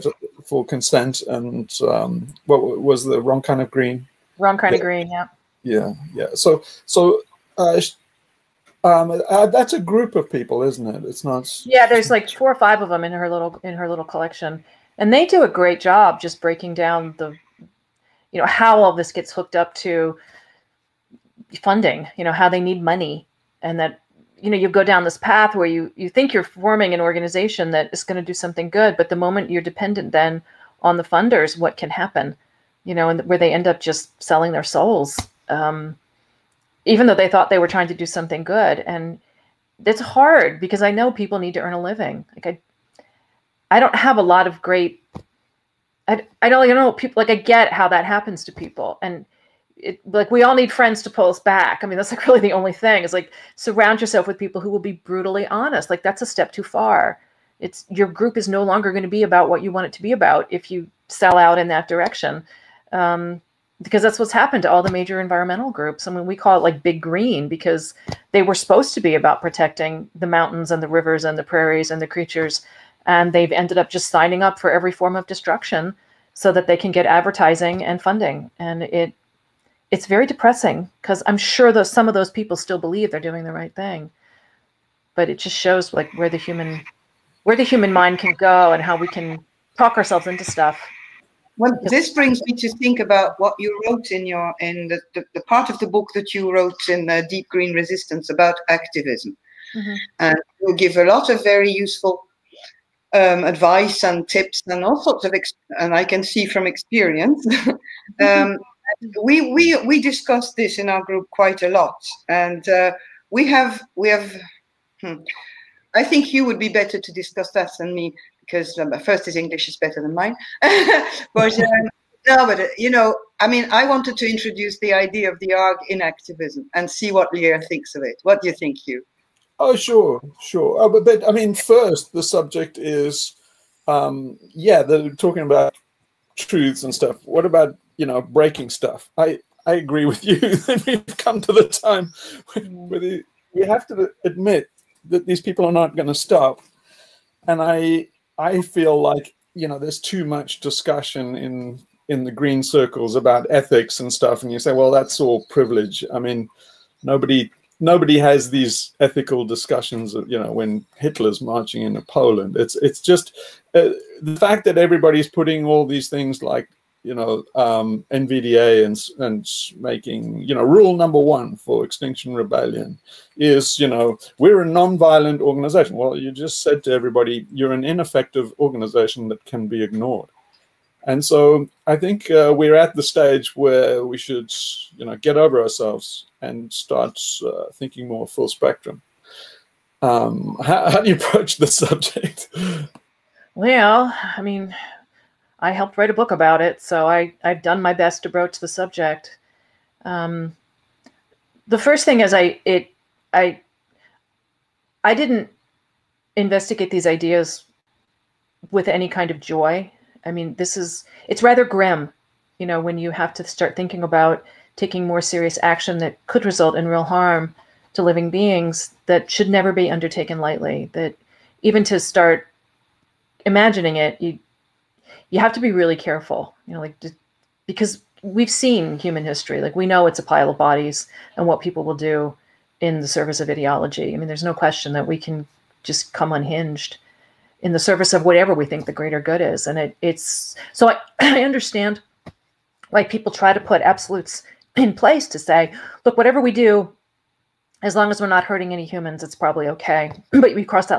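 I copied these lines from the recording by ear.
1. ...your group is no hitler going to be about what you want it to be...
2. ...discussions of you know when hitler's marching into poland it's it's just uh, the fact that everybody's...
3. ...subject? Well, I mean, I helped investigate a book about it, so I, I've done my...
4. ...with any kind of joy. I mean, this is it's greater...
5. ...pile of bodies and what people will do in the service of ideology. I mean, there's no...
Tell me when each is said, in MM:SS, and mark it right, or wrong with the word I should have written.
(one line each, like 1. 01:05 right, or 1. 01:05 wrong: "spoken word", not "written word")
1. 00:57 wrong: "longer", not "hitler"
2. 02:39 right
3. 03:11 wrong: "write", not "investigate"
4. 03:28 wrong: "rather", not "greater"
5. 03:50 right.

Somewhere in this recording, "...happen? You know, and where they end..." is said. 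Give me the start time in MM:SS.
00:31.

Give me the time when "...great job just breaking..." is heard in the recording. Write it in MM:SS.
00:15.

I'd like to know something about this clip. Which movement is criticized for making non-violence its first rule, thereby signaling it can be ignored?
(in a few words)
Extinction Rebellion.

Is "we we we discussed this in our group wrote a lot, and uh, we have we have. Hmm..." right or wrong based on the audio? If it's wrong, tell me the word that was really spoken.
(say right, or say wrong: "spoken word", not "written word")
wrong: "quite", not "wrote".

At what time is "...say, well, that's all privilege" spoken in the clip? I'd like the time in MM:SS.
02:34.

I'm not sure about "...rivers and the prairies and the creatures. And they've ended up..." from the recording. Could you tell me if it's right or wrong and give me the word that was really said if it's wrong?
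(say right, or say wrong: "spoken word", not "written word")
right.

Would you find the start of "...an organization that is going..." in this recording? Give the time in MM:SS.
00:26.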